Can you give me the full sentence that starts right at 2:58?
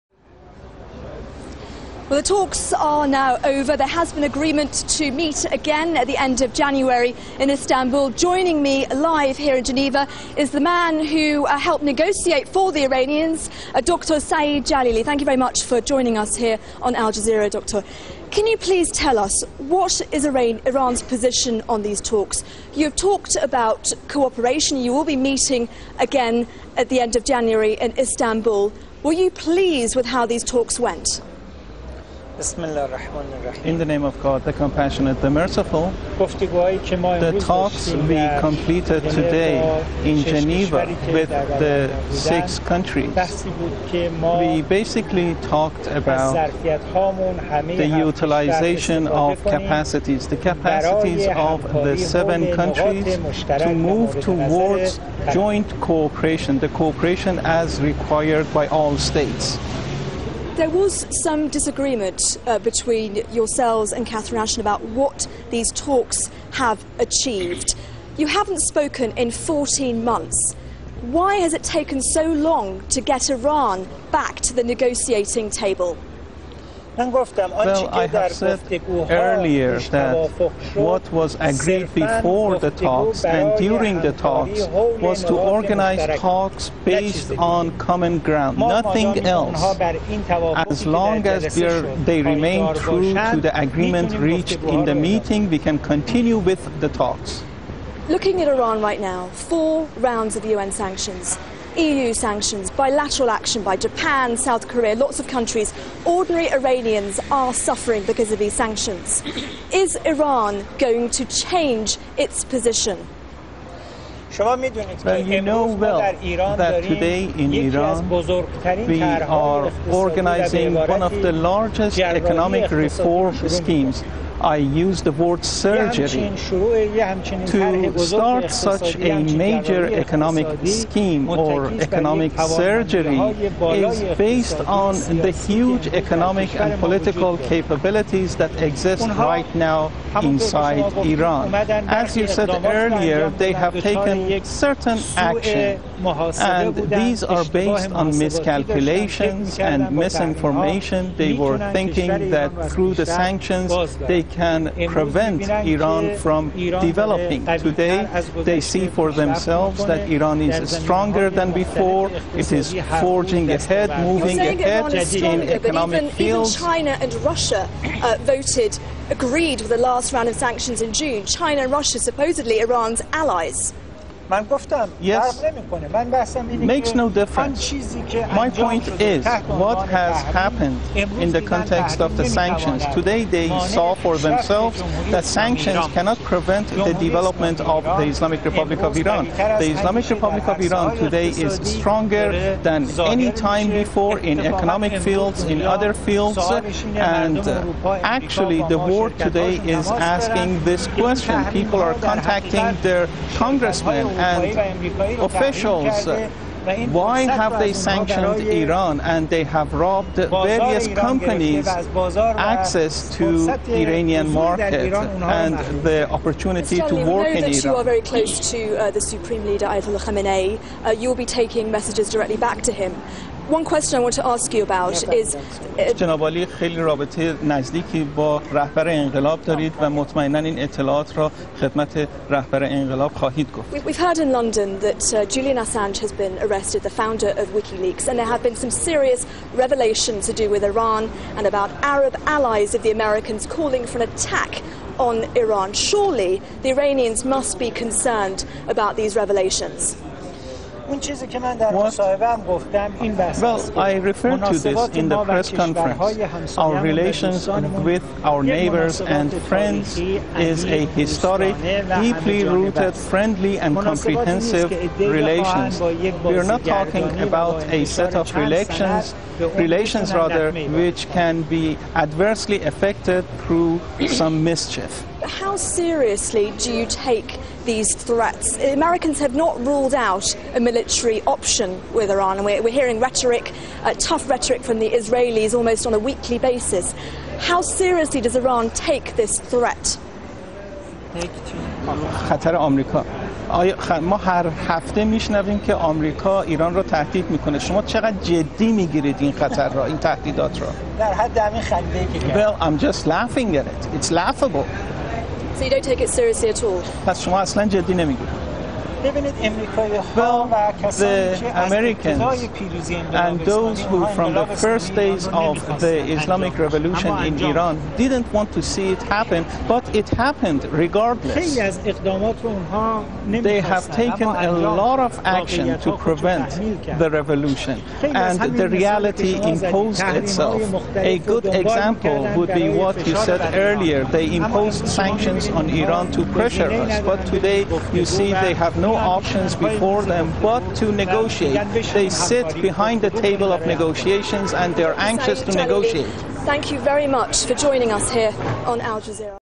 My point is what has happened in the context of the sanctions.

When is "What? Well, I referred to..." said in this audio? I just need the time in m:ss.
4:10.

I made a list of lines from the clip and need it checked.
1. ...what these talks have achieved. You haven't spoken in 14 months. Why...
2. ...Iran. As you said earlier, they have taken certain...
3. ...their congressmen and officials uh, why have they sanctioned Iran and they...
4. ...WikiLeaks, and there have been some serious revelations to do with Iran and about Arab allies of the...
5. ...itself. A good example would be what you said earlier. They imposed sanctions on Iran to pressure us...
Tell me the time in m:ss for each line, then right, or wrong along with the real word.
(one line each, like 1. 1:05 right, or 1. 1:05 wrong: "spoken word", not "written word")
1. 1:04 right
2. 2:21 right
3. 3:22 right
4. 3:57 right
5. 5:30 right.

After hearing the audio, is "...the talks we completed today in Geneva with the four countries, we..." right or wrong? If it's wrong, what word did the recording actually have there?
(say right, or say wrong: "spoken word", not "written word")
wrong: "six", not "four".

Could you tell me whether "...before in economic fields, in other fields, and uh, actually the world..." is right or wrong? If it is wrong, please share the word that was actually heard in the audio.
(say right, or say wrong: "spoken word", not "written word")
right.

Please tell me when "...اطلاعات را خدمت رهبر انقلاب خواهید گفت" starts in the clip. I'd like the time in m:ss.
3:50.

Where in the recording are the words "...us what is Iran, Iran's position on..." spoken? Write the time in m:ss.
0:19.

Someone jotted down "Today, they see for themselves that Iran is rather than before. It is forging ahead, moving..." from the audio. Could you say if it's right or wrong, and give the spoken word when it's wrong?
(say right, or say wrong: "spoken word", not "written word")
wrong: "stronger", not "rather".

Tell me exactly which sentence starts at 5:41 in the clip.
They sit behind the table of negotiations and they're anxious to negotiate.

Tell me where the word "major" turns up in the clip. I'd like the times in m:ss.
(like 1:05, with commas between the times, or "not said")
2:09.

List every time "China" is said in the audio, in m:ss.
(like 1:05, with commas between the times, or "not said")
2:46, 2:51.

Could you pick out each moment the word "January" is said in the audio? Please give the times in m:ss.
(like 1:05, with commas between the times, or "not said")
0:06, 0:27.